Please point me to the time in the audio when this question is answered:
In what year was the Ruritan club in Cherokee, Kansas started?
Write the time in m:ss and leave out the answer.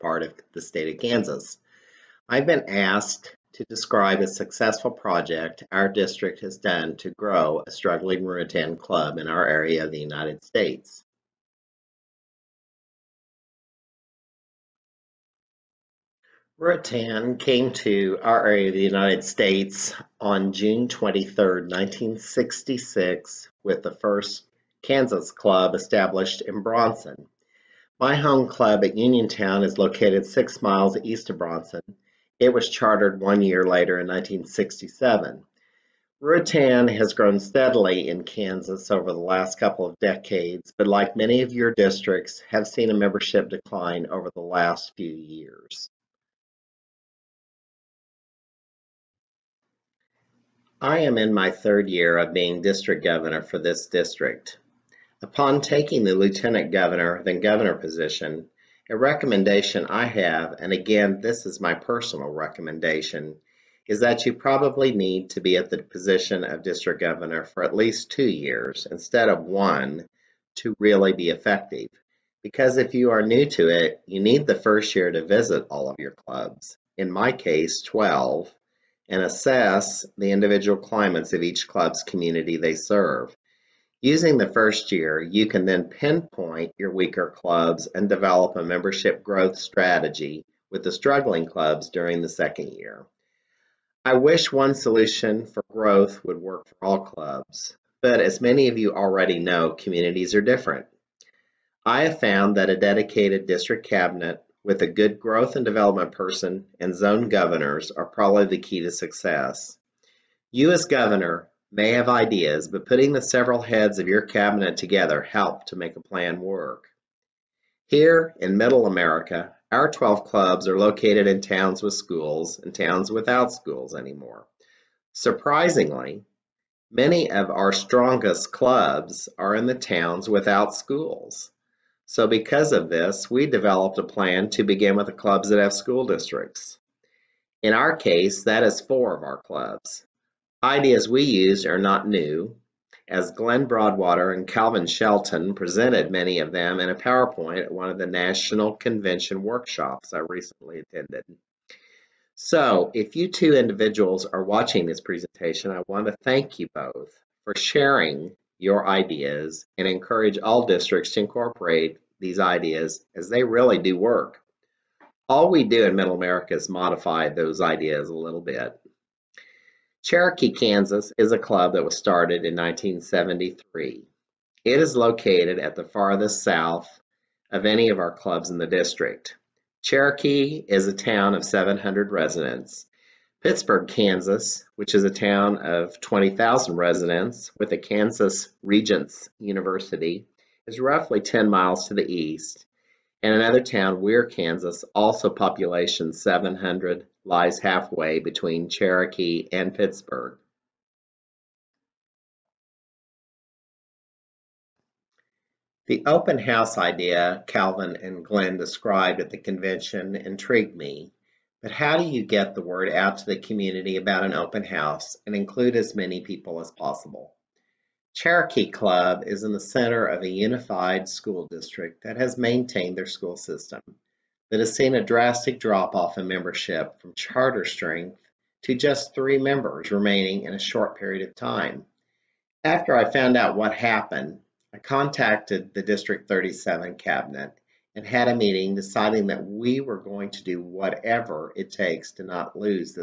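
2:52.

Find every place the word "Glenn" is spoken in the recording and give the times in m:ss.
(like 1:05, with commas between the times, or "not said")
2:23, 3:28.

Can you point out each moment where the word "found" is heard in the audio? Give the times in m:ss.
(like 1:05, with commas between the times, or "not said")
1:42, 3:53.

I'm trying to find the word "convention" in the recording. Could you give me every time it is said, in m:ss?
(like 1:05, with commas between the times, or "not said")
2:28, 3:29.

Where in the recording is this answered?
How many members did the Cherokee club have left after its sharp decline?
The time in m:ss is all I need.
3:49.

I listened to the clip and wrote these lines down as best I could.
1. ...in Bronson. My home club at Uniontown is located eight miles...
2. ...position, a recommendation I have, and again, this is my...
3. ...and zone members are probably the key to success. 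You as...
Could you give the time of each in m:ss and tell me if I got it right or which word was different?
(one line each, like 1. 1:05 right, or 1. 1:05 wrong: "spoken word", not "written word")
1. 0:26 wrong: "six", not "eight"
2. 0:57 right
3. 1:46 wrong: "governors", not "members".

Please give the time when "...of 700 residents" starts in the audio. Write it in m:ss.
3:01.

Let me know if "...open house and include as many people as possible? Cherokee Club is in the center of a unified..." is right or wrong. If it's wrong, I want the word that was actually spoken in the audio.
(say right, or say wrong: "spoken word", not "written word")
right.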